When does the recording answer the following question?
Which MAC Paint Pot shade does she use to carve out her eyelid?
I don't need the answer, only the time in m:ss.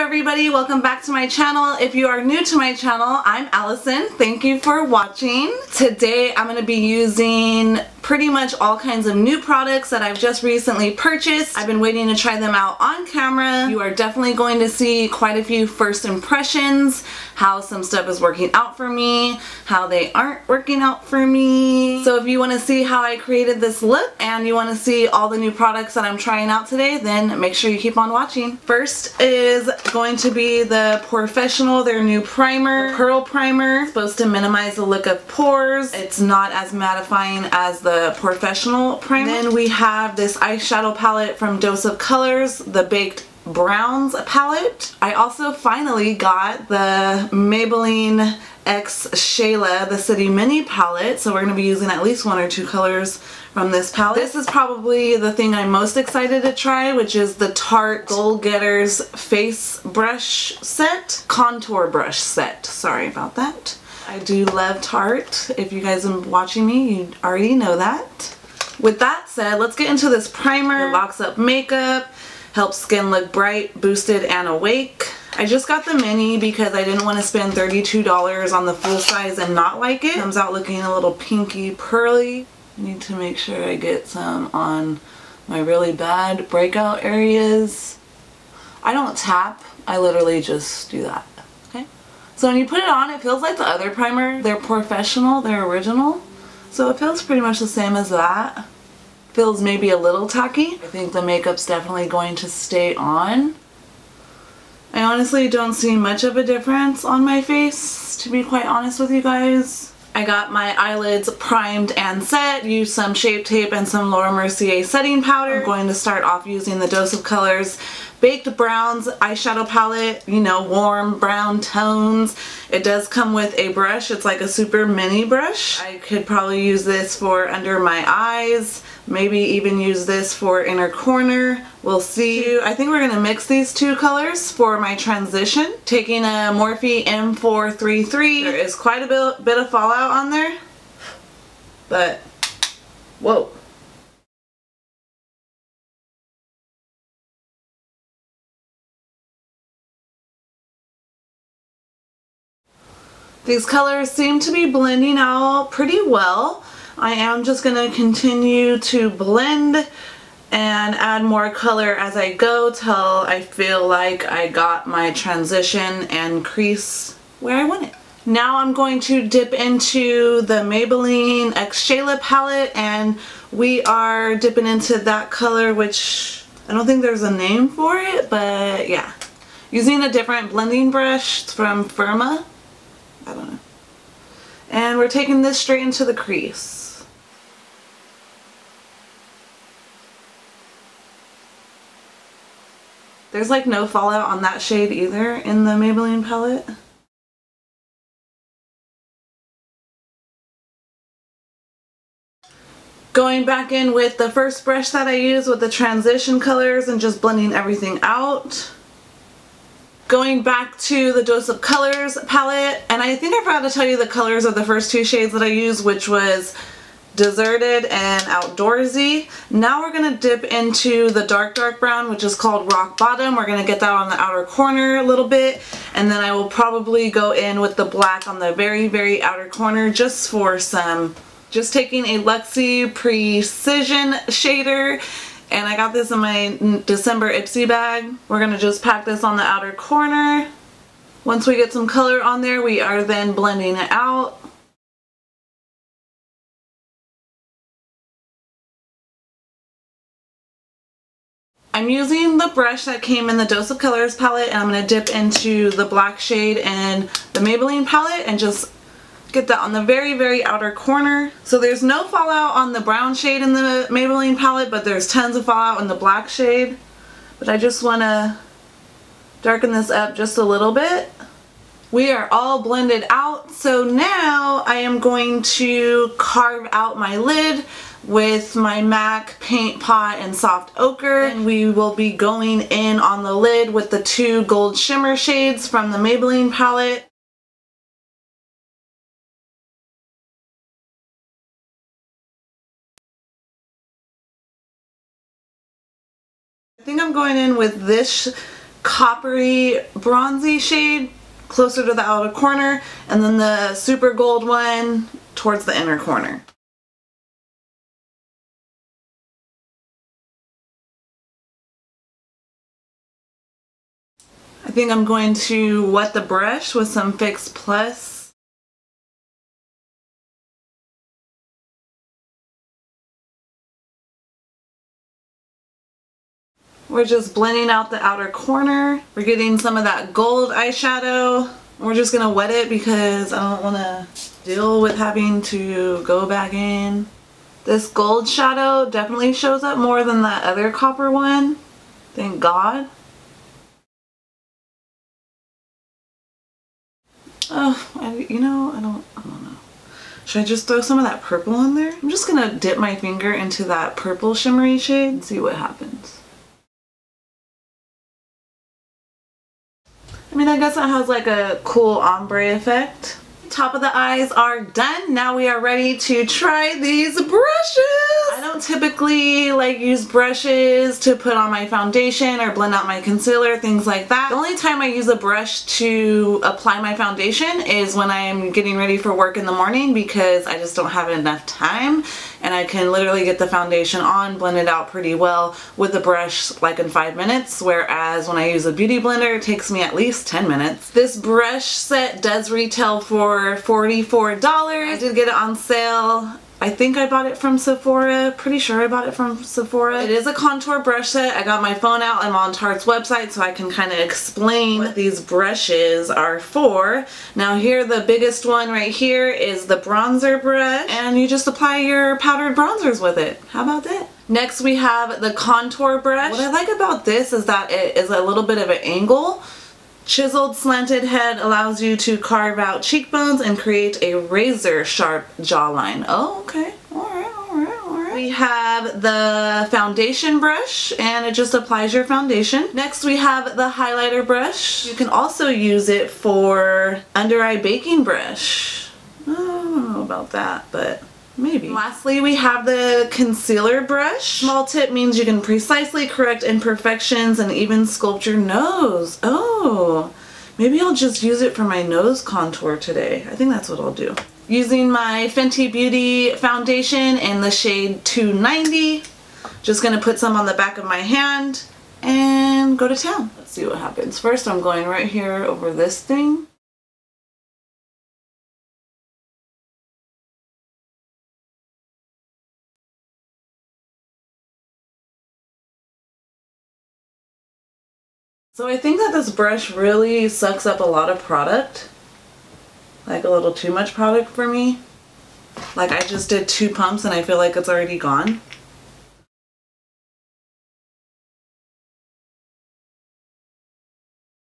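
4:40.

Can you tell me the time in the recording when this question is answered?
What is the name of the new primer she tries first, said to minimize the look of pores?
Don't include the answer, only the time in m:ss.
0:32.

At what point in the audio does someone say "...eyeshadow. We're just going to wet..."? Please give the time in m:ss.
5:30.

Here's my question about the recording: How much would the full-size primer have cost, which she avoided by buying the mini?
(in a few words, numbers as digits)
$32.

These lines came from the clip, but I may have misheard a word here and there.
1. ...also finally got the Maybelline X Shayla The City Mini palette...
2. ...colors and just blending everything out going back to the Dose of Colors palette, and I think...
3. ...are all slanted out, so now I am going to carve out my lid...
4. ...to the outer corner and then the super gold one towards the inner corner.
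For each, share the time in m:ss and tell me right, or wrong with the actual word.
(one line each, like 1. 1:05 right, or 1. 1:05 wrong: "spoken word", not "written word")
1. 0:45 right
2. 3:26 right
3. 4:32 wrong: "blended", not "slanted"
4. 5:01 right.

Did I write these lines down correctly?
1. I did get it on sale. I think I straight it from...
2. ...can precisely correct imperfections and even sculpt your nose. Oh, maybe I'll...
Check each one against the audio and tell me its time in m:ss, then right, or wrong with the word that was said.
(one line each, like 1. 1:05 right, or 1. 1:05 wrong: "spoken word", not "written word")
1. 6:34 wrong: "bought", not "straight"
2. 7:25 right.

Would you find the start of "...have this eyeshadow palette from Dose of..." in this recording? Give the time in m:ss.
0:39.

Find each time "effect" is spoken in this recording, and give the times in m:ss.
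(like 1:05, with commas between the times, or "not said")
6:02.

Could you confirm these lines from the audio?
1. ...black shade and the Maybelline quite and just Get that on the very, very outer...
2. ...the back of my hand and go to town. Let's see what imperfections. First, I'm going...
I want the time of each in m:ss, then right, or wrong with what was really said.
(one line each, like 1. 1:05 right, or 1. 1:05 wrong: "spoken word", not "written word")
1. 4:15 wrong: "palette", not "quite"
2. 7:40 wrong: "happens", not "imperfections".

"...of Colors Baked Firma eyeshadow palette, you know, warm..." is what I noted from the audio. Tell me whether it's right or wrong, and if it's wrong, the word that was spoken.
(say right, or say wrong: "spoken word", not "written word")
wrong: "Browns", not "Firma".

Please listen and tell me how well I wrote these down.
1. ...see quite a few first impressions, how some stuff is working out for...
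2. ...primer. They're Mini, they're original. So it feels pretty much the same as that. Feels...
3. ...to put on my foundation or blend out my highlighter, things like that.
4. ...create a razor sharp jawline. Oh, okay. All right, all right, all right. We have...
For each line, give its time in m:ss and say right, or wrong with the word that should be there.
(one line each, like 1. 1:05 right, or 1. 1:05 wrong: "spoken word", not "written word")
1. 0:14 right
2. 1:33 wrong: "POREfessional", not "Mini"
3. 6:10 wrong: "concealer", not "highlighter"
4. 7:03 right.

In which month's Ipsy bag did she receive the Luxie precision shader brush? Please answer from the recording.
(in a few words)
December.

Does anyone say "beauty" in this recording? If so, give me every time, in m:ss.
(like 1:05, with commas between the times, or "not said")
6:28, 7:35.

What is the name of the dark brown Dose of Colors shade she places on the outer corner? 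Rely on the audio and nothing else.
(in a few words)
Rock Bottom.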